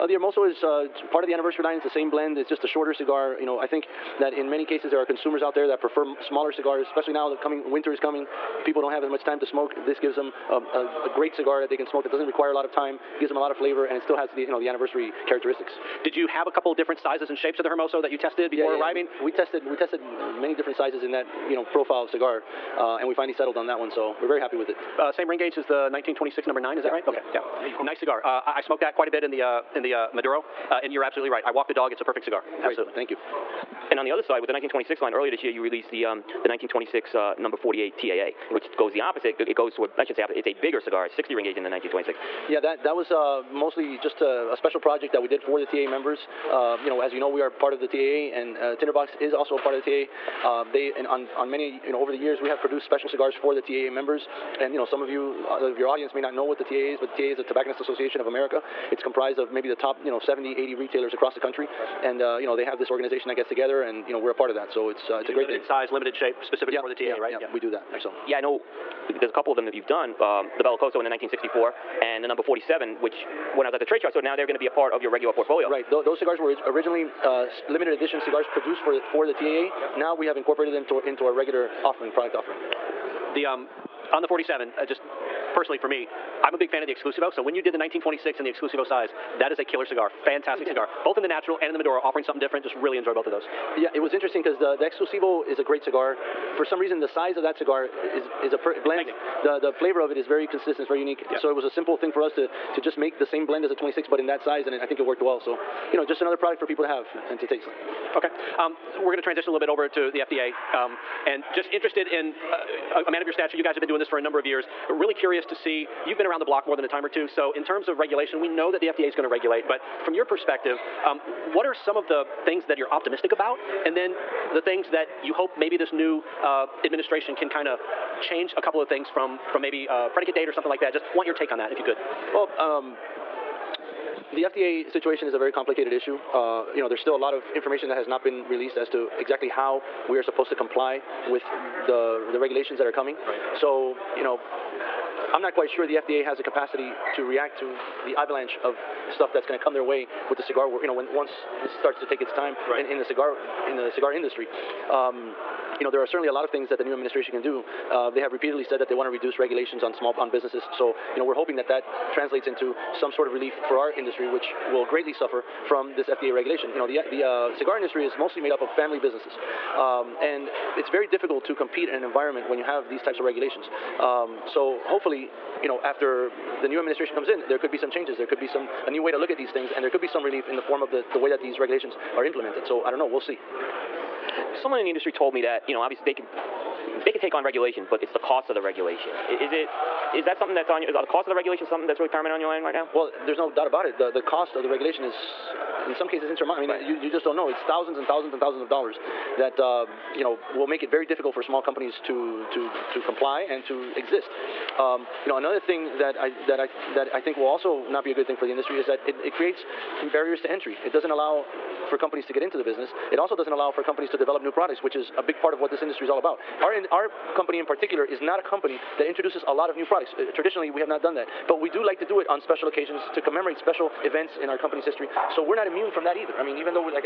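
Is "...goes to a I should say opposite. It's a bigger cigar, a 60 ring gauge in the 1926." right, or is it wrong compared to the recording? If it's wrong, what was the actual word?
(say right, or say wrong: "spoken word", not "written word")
right.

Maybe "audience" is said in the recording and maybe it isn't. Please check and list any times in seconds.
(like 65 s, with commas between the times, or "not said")
55 s.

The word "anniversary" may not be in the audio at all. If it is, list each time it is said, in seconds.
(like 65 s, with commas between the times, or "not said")
1 s, 14 s.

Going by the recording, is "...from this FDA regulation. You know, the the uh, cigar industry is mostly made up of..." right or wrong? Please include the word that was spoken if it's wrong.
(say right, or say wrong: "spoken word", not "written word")
right.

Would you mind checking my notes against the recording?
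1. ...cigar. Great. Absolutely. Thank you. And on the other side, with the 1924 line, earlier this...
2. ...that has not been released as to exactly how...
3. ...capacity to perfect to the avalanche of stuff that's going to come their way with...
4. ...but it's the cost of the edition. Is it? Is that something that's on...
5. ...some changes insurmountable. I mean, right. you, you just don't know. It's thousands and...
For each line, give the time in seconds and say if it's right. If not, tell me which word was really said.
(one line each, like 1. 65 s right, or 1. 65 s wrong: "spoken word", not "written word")
1. 32 s wrong: "1926", not "1924"
2. 137 s right
3. 146 s wrong: "react", not "perfect"
4. 187 s wrong: "regulation", not "edition"
5. 195 s wrong: "cases", not "changes".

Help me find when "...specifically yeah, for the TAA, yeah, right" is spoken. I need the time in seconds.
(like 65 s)
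66 s.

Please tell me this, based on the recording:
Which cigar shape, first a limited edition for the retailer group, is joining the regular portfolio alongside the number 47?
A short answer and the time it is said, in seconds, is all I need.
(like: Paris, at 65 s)
Bellicoso, at 70 s.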